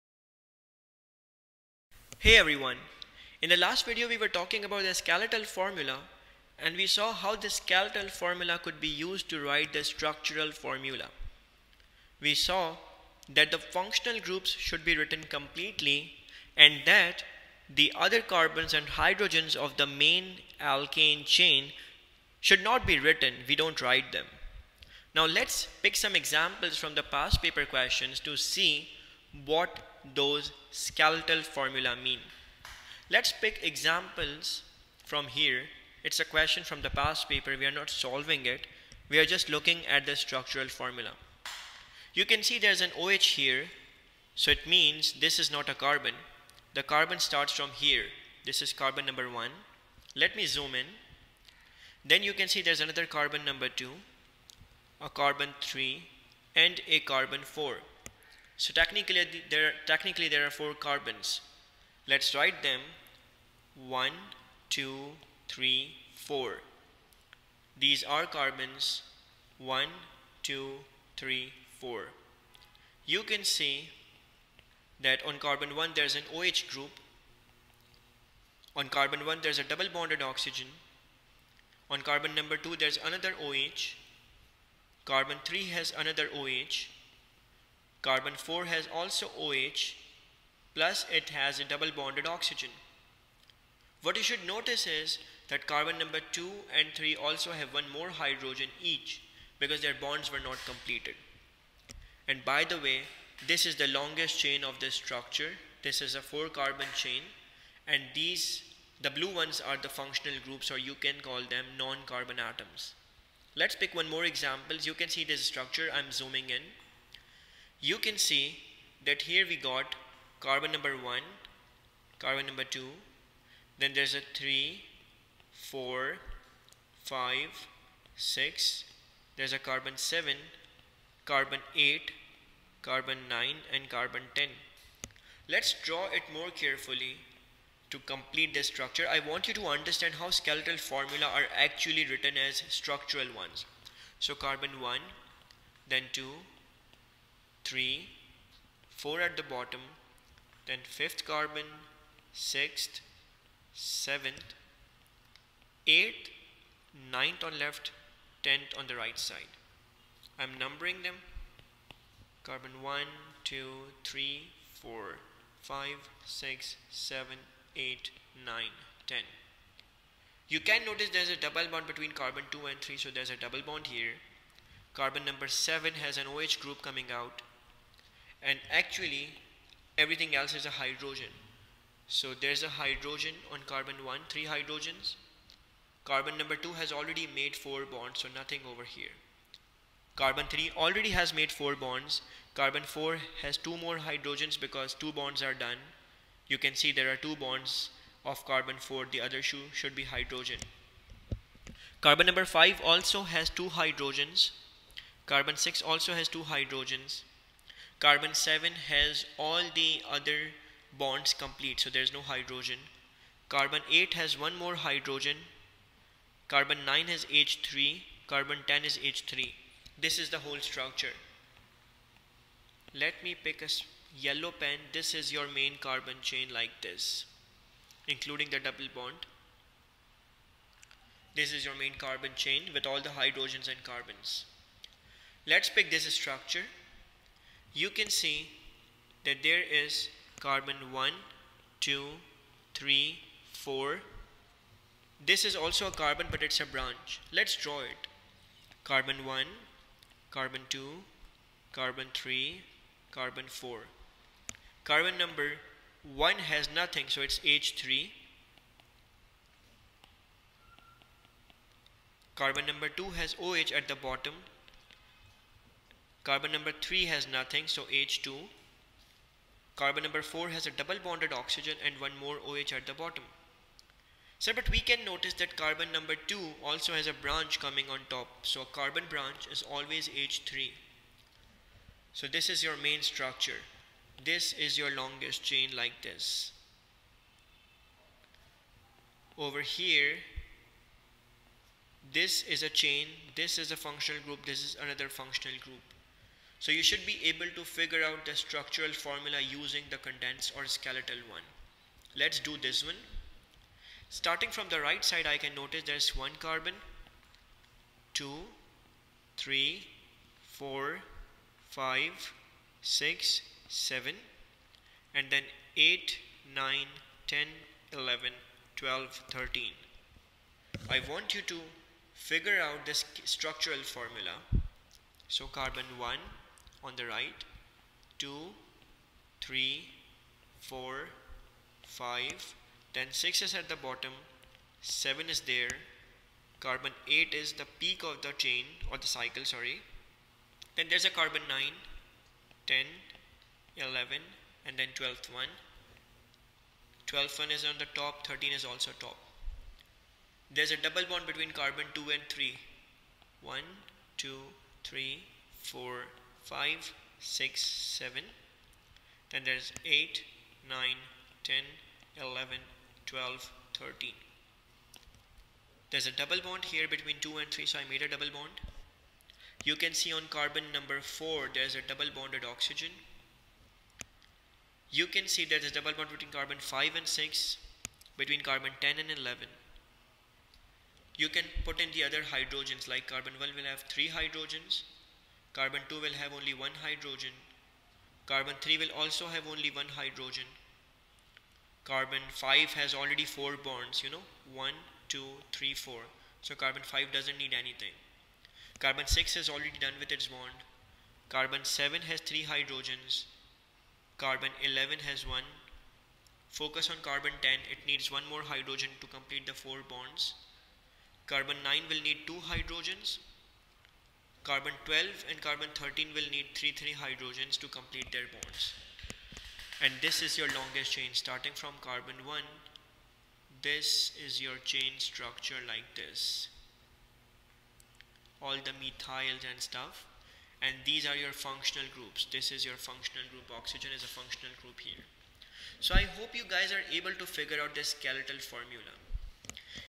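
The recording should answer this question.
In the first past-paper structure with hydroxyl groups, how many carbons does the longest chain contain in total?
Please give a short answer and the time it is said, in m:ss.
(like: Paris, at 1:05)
4, at 1:00.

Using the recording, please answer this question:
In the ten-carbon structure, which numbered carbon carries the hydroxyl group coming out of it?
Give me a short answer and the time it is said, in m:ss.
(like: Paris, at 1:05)
7, at 2:54.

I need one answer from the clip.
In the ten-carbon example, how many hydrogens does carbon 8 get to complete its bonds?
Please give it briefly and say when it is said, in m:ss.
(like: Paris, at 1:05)
1, at 3:33.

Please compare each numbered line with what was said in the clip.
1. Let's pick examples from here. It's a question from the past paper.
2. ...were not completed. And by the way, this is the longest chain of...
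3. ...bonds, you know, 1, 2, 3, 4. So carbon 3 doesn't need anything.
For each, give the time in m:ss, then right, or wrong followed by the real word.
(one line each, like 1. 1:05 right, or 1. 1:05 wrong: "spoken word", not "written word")
1. 0:33 right
2. 1:40 right
3. 6:33 wrong: "5", not "3".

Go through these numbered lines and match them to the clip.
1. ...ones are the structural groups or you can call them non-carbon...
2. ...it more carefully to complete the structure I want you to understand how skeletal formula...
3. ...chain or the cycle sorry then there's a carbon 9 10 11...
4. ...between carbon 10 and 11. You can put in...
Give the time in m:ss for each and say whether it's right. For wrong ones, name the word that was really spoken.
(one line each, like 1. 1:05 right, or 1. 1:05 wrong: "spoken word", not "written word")
1. 1:49 wrong: "functional", not "structural"
2. 2:16 right
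3. 5:38 right
4. 6:18 right.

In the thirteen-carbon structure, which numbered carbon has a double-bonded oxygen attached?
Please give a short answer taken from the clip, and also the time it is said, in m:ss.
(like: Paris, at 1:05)
4, at 6:10.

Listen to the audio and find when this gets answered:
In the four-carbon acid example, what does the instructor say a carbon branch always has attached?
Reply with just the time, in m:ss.
4:38.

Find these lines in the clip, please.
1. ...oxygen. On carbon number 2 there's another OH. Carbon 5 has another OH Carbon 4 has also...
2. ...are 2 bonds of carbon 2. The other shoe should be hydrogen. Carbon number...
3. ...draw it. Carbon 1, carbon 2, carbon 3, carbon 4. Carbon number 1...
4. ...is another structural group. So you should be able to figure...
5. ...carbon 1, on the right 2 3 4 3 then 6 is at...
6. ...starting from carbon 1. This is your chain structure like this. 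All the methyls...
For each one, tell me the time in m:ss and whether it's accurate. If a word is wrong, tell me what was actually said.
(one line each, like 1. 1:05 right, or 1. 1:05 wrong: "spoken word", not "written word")
1. 1:20 wrong: "3", not "5"
2. 3:17 wrong: "4", not "2"
3. 4:07 right
4. 4:54 wrong: "functional", not "structural"
5. 5:25 wrong: "5", not "3"
6. 7:01 right.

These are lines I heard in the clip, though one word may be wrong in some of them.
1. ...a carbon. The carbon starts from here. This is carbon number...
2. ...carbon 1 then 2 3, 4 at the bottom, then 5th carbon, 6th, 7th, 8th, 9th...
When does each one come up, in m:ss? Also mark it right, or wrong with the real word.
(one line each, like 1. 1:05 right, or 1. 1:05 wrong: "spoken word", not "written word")
1. 0:45 right
2. 2:24 right.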